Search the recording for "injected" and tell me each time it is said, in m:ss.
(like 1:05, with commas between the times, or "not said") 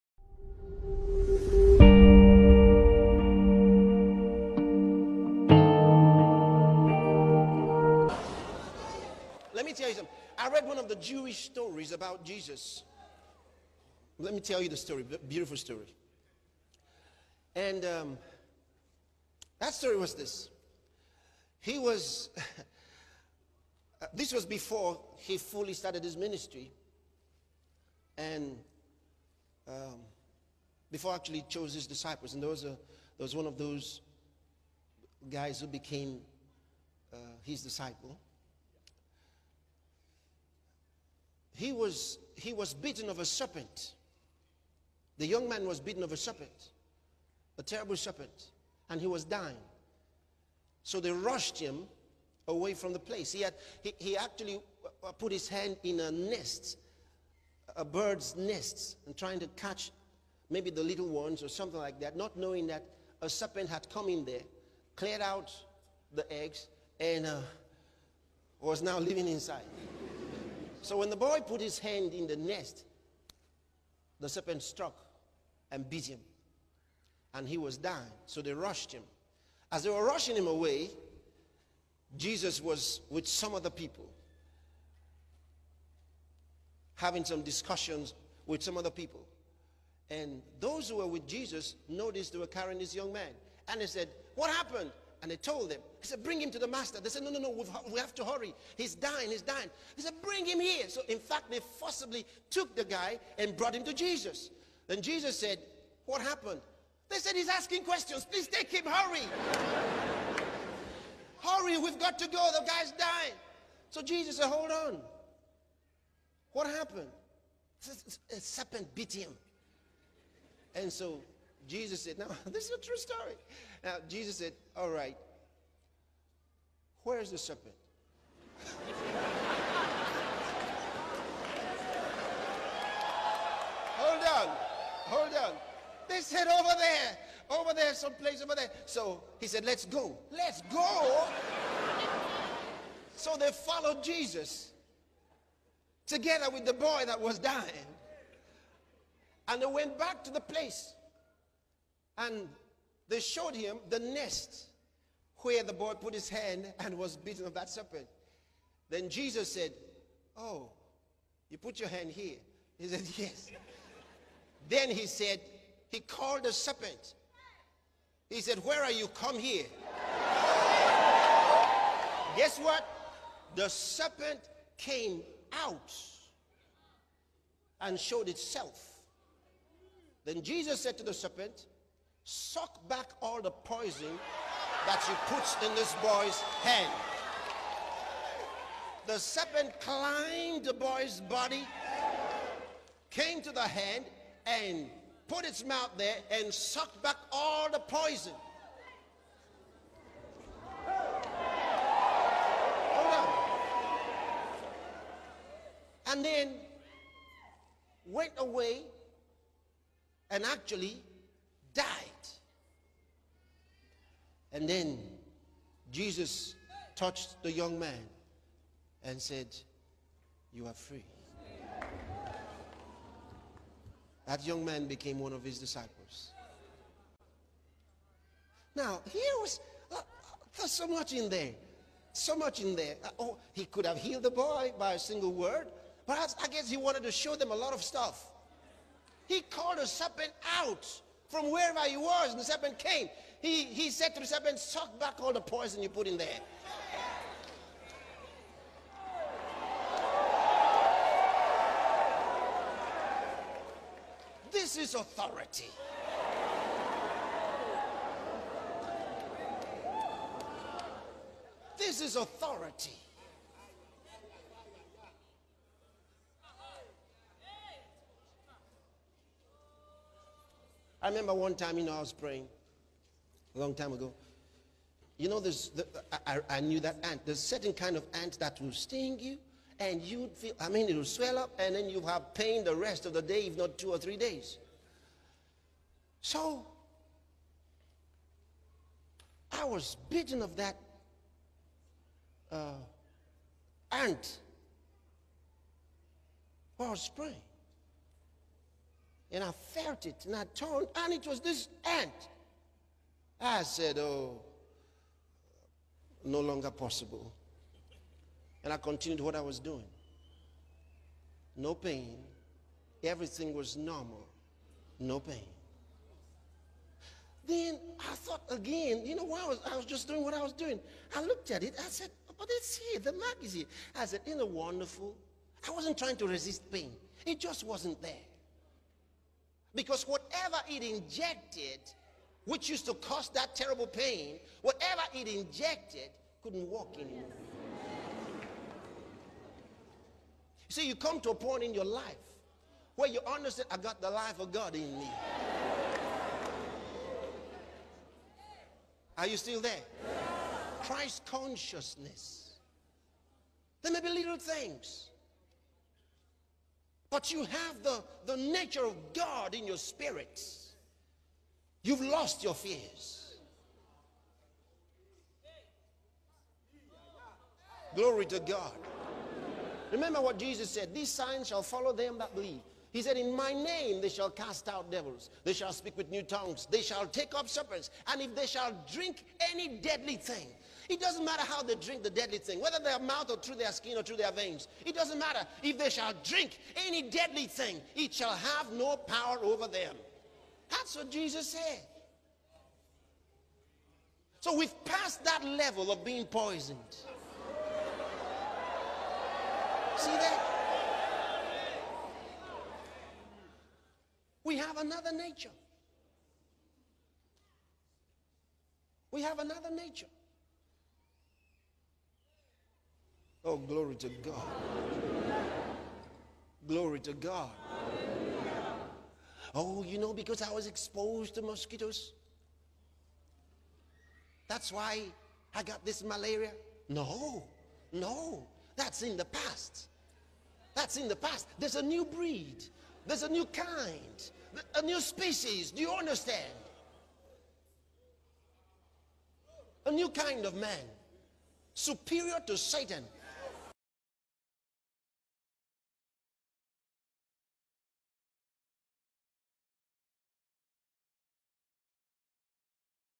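5:30, 5:35.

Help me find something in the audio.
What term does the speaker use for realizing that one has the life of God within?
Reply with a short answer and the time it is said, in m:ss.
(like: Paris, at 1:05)
Christ consciousness, at 5:50.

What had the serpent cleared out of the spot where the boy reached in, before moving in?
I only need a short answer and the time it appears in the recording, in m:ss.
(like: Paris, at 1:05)
The eggs, at 1:06.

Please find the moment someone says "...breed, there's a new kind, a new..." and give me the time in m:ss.
7:12.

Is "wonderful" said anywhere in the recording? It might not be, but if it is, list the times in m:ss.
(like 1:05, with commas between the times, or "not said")
5:24.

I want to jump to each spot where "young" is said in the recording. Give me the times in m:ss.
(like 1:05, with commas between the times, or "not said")
0:45, 1:32, 3:37, 3:44.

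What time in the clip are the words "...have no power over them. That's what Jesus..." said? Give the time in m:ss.
6:28.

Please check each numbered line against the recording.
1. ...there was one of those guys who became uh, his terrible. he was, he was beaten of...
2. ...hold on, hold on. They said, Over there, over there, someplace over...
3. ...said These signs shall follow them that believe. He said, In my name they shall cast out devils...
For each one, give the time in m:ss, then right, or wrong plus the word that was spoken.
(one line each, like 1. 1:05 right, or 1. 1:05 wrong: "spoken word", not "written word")
1. 0:32 wrong: "disciple", not "terrible"
2. 2:13 right
3. 6:10 right.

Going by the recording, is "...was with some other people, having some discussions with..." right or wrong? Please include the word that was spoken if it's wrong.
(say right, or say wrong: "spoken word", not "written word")
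right.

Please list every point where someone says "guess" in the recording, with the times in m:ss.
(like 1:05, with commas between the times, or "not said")
2:52, 3:56.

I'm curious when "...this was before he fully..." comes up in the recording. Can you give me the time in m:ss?
0:24.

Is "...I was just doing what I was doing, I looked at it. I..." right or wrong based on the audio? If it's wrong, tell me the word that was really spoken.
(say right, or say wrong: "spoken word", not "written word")
right.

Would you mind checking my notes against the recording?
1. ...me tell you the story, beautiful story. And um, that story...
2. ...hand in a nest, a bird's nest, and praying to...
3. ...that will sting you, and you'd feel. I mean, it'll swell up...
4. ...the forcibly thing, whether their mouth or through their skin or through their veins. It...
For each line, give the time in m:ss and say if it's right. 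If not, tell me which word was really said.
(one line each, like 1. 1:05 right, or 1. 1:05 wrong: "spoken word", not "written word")
1. 0:14 right
2. 0:55 wrong: "trying", not "praying"
3. 4:38 right
4. 6:22 wrong: "deadly", not "forcibly".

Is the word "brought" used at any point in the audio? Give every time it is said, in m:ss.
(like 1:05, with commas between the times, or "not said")
1:43.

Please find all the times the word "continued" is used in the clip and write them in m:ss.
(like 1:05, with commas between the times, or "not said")
5:08.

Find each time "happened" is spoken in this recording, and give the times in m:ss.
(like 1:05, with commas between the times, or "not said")
1:34, 1:46, 1:56.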